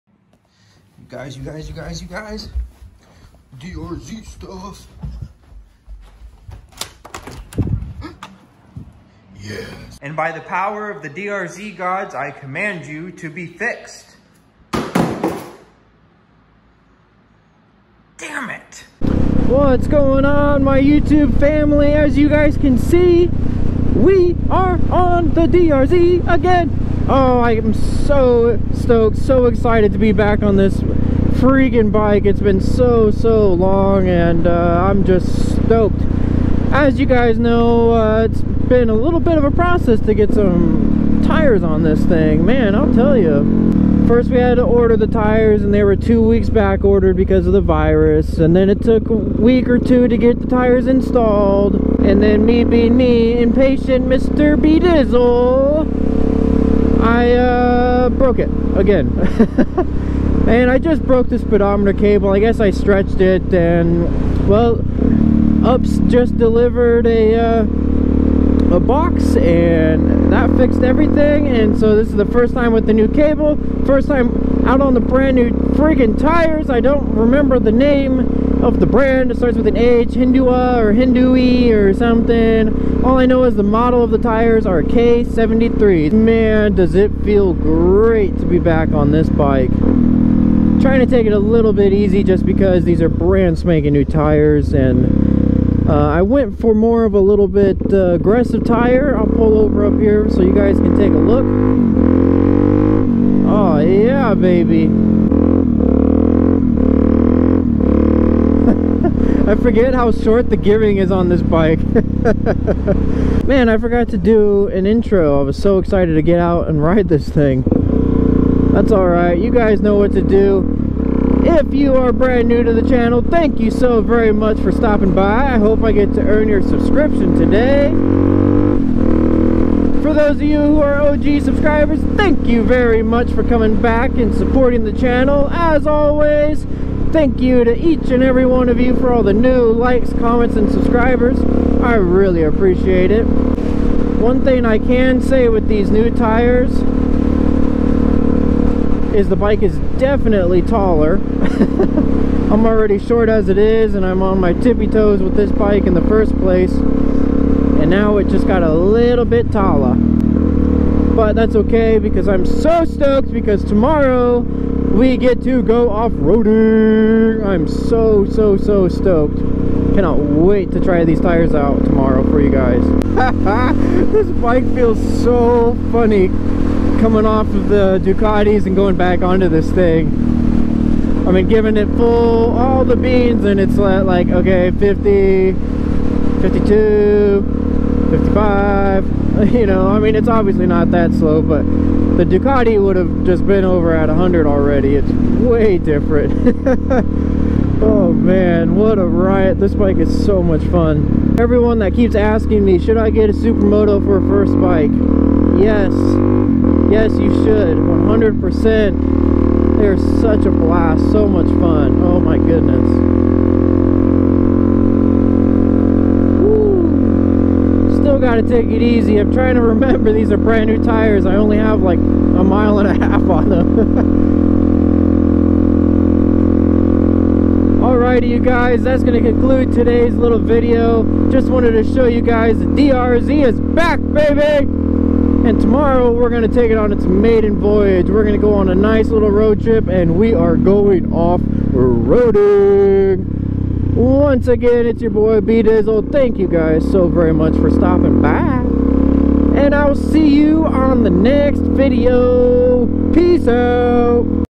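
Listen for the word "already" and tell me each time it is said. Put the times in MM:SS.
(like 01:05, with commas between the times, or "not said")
02:32, 03:14.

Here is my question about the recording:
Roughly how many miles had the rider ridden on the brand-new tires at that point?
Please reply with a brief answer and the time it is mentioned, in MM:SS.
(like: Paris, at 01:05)
1.5, at 03:41.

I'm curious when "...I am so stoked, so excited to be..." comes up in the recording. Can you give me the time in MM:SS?
00:27.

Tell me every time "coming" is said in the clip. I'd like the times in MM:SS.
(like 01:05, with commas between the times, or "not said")
02:13, 02:57.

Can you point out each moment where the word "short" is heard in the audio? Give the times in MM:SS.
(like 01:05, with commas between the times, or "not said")
01:50, 02:32.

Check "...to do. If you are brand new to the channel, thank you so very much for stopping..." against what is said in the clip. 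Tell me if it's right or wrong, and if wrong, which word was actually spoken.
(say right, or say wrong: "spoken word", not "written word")
right.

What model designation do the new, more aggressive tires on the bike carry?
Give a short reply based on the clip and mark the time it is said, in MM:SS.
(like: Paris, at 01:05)
K73, at 01:24.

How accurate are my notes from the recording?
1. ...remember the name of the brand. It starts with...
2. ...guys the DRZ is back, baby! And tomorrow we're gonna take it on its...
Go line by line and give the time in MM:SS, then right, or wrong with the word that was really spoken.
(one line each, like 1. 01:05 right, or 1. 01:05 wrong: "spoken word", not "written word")
1. 01:17 right
2. 03:52 right.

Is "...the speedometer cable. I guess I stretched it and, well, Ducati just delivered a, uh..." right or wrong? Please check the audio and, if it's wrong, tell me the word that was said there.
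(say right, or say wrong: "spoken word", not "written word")
wrong: "UPS", not "Ducati".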